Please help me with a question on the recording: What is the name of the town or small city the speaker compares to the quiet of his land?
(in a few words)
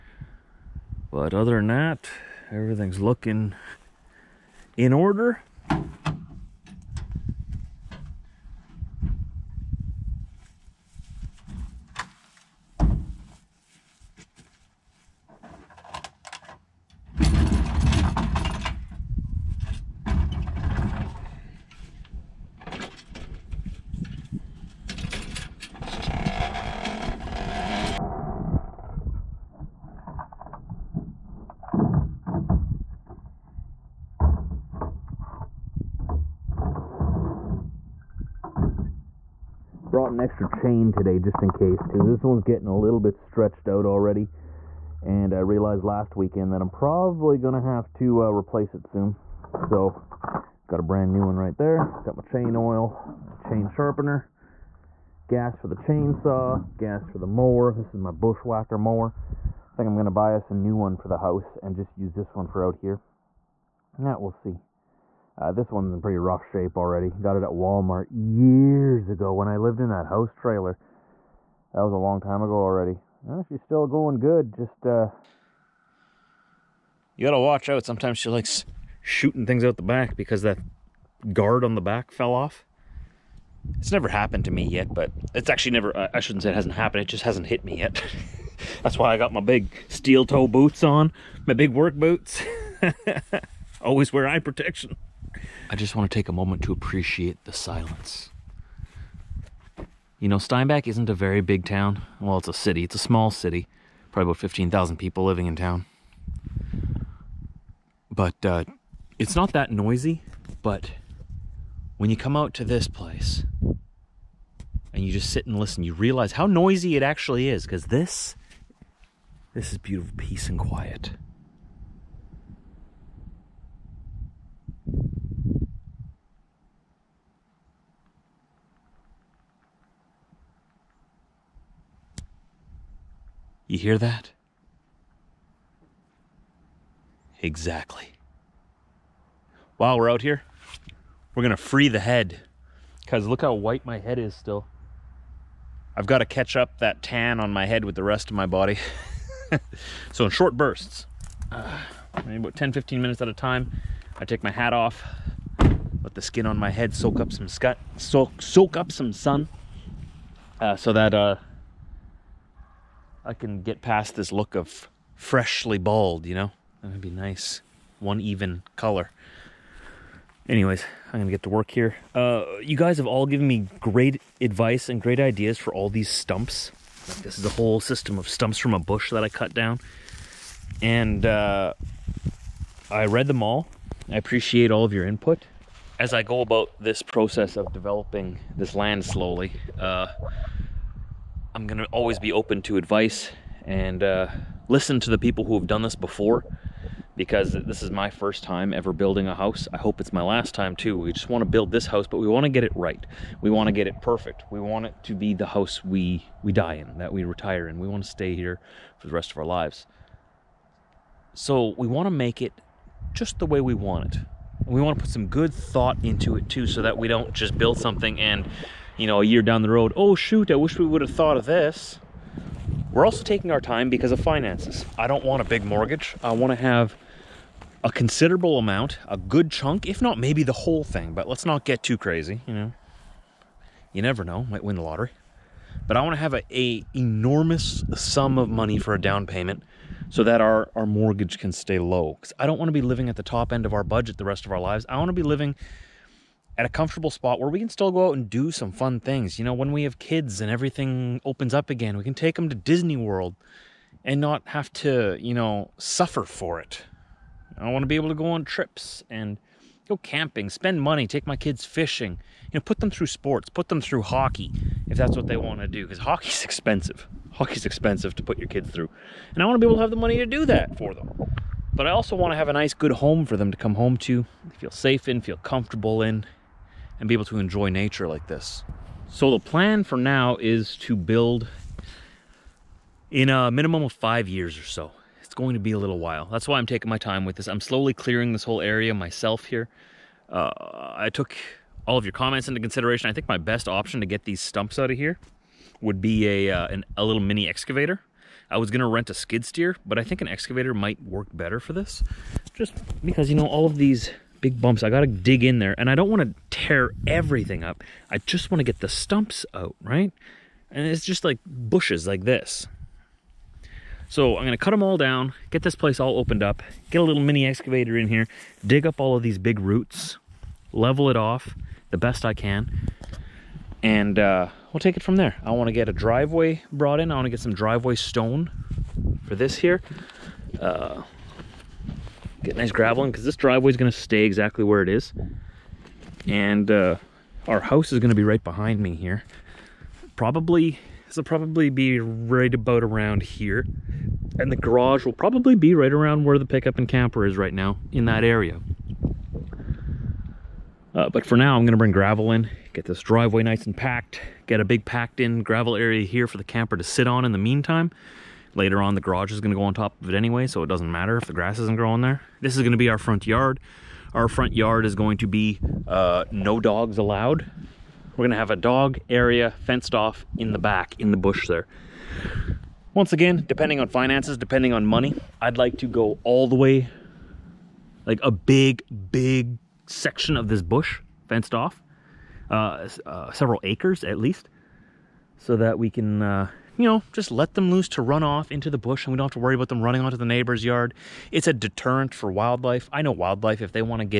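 Steinbach.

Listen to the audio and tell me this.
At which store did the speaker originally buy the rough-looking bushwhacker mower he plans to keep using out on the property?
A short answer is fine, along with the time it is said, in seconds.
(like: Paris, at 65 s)
Walmart, at 67 s.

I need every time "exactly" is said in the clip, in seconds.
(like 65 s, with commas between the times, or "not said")
137 s, 334 s.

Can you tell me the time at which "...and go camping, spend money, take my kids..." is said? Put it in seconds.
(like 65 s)
259 s.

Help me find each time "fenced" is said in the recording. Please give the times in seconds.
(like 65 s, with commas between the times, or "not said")
369 s, 381 s.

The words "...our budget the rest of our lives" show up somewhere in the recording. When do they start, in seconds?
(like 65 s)
243 s.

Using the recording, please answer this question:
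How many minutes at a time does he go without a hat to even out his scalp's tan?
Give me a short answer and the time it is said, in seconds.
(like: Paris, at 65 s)
10 to 15 minutes, at 152 s.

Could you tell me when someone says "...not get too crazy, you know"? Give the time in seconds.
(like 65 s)
231 s.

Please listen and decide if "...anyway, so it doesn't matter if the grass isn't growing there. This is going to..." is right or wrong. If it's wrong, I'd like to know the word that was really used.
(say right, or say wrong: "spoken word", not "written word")
right.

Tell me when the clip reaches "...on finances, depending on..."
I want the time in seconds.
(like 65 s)
373 s.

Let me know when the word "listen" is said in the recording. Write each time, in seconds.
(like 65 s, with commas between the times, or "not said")
115 s, 194 s.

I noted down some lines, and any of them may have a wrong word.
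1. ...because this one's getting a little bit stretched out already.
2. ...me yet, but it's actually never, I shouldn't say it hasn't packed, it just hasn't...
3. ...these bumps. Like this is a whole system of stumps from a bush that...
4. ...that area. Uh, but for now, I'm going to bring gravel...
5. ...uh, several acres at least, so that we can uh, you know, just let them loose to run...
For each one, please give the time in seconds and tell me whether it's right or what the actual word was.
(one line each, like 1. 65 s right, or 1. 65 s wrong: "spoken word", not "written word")
1. 41 s right
2. 84 s wrong: "happened", not "packed"
3. 175 s wrong: "stumps", not "bumps"
4. 348 s right
5. 383 s right.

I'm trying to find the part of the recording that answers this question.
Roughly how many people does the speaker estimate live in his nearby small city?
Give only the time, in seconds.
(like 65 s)
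104 s.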